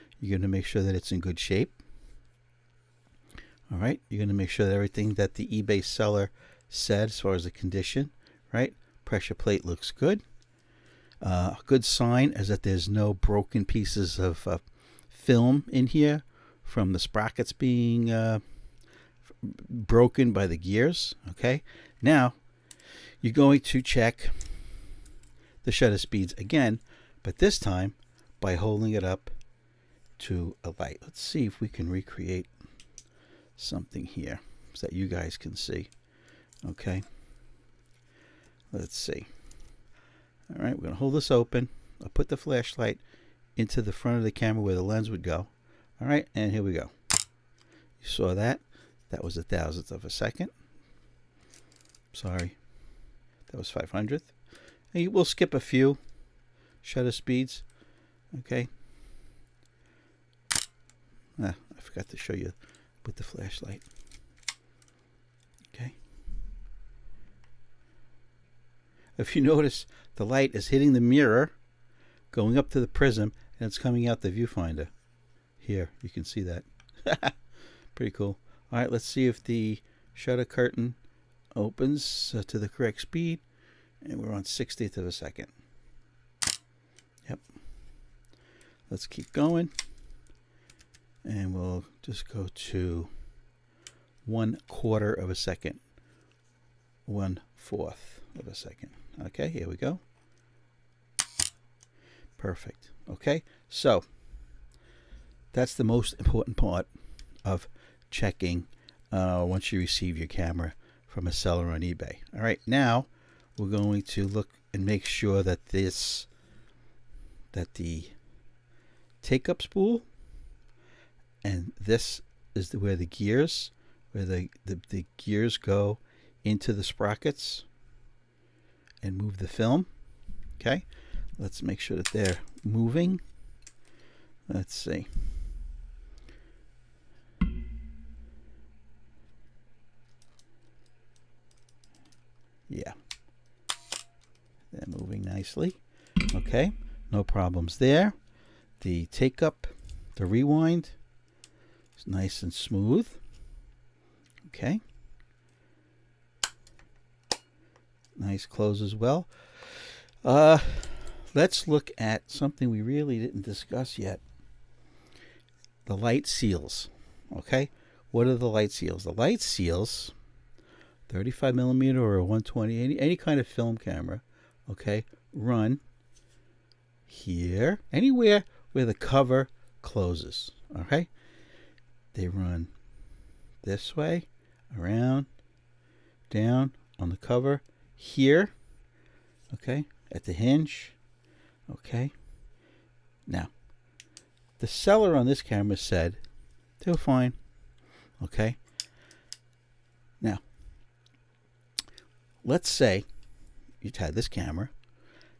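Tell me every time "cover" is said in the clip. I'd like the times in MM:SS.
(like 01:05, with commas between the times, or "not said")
02:58, 03:07.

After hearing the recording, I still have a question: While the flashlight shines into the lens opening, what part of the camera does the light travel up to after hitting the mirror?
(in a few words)
the prism.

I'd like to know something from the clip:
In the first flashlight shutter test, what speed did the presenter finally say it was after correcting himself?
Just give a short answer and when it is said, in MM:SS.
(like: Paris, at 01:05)
1/500, at 00:53.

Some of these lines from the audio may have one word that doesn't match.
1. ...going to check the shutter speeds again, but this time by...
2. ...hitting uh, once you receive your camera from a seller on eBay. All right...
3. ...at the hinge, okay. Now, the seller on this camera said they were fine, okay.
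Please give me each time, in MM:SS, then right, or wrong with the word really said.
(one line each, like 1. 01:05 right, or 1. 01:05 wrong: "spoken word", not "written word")
1. 00:23 right
2. 01:48 wrong: "checking", not "hitting"
3. 03:10 right.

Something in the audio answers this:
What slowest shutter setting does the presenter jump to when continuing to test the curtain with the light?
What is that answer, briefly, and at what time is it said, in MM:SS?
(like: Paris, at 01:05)
1/4 second, at 01:34.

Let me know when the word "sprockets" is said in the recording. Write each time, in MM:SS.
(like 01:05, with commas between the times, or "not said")
00:16, 02:06.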